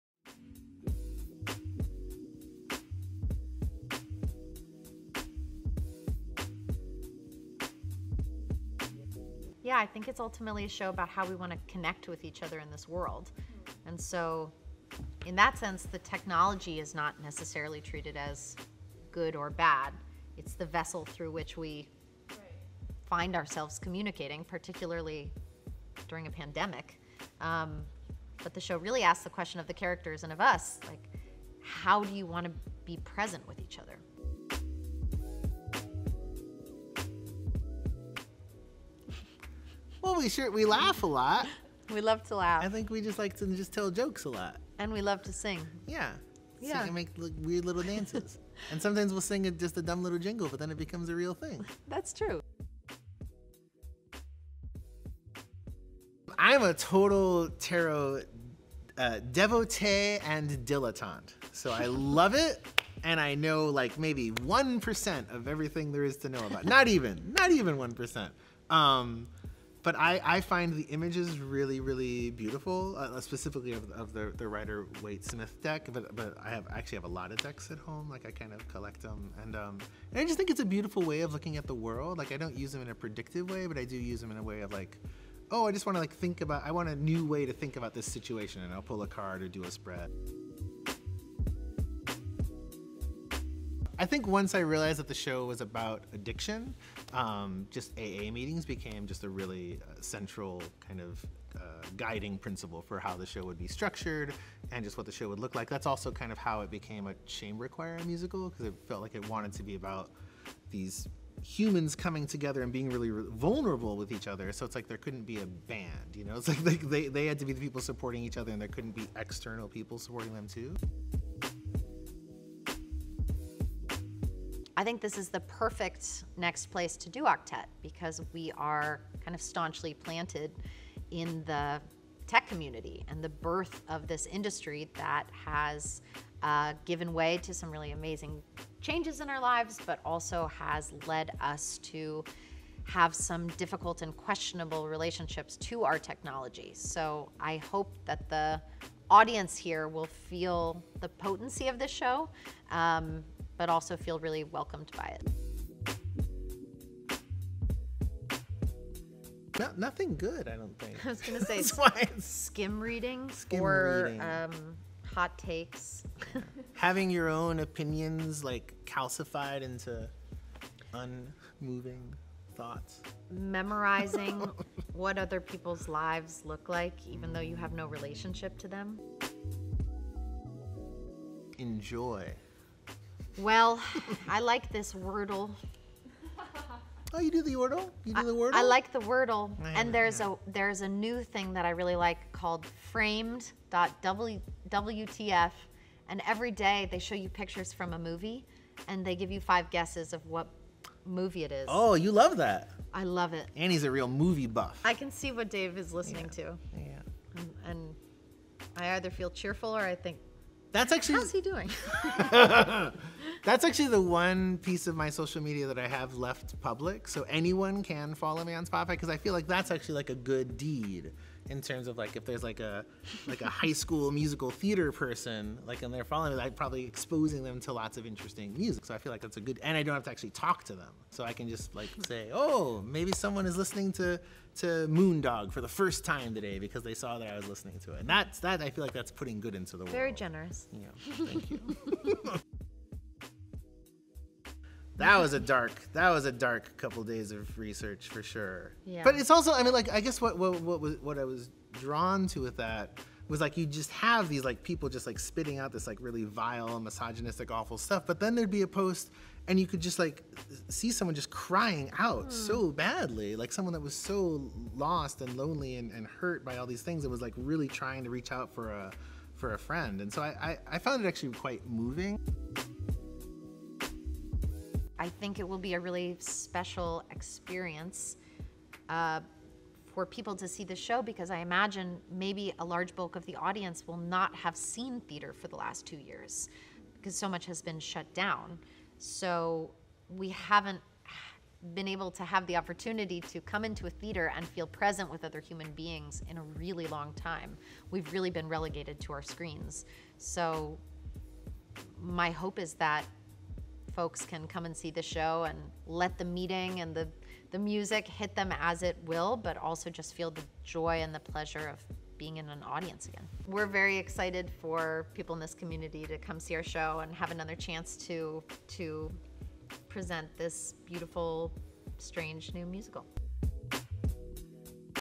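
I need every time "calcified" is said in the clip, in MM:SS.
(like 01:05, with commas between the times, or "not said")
02:48.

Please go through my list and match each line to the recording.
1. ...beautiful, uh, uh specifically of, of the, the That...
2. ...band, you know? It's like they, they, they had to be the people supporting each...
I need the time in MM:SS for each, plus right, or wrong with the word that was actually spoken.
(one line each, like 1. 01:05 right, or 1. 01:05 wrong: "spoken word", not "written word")
1. 01:12 wrong: "Rider", not "That"
2. 01:55 right.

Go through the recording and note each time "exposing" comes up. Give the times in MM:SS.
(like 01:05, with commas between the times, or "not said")
03:46.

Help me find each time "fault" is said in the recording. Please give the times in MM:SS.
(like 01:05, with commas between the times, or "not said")
not said.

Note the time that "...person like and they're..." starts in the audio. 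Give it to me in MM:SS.
03:44.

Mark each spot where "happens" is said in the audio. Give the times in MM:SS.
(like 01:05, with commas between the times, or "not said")
not said.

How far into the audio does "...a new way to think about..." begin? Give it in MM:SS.
01:26.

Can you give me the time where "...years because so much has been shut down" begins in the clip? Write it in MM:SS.
04:45.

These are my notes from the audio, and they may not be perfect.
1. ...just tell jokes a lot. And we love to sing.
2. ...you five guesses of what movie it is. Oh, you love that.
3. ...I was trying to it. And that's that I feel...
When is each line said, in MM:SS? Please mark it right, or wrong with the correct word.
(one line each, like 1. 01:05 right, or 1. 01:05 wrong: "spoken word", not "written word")
1. 00:43 right
2. 03:19 right
3. 03:57 wrong: "listening", not "trying".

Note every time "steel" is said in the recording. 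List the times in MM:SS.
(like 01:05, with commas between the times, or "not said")
not said.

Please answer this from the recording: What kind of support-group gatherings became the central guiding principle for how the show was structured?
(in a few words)
AA meetings.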